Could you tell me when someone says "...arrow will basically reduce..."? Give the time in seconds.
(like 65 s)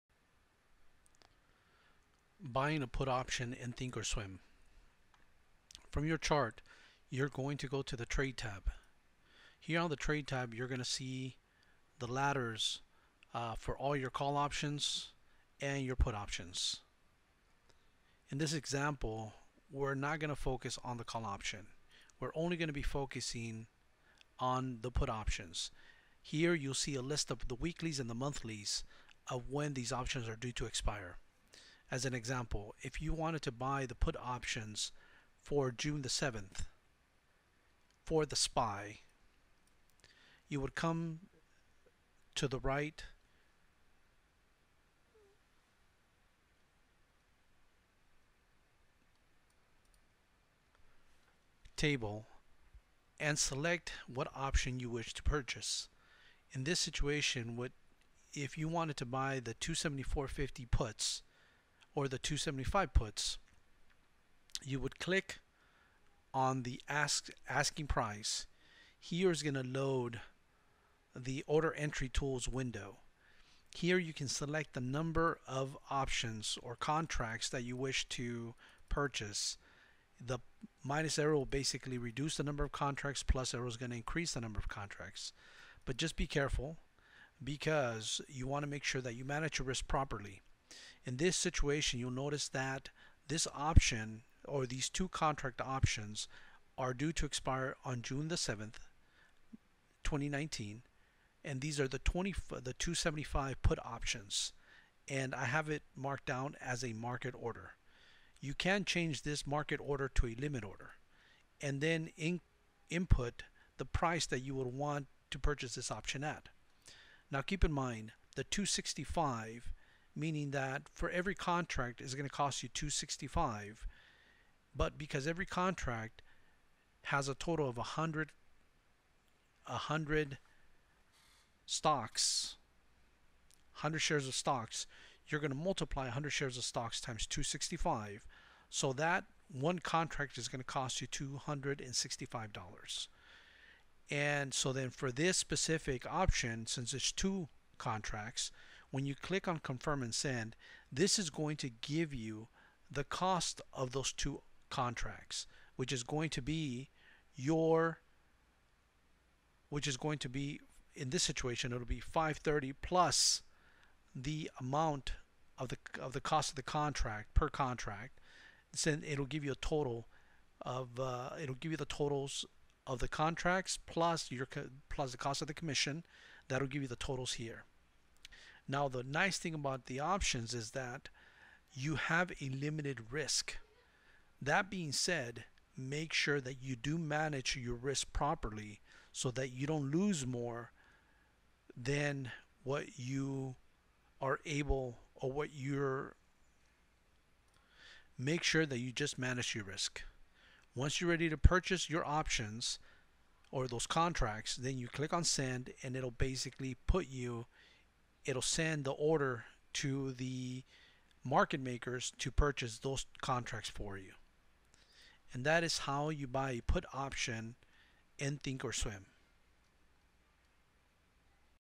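81 s.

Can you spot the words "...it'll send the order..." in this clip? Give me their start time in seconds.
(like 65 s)
208 s.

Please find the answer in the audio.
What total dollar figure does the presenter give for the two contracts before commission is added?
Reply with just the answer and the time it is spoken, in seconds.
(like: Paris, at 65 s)
530, at 162 s.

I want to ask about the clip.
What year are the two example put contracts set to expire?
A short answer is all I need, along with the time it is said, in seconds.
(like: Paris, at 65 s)
2019, at 100 s.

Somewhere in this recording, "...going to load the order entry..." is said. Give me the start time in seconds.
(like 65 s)
69 s.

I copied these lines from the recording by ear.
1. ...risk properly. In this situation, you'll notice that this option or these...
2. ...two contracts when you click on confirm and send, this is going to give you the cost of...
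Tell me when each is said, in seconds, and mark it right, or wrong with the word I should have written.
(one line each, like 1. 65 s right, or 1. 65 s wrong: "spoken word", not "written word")
1. 89 s right
2. 147 s right.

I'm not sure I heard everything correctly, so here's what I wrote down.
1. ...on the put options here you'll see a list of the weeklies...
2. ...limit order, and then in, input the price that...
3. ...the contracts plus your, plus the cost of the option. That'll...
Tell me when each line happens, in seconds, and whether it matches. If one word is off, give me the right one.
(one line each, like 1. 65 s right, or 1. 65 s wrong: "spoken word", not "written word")
1. 24 s right
2. 110 s right
3. 172 s wrong: "commission", not "option".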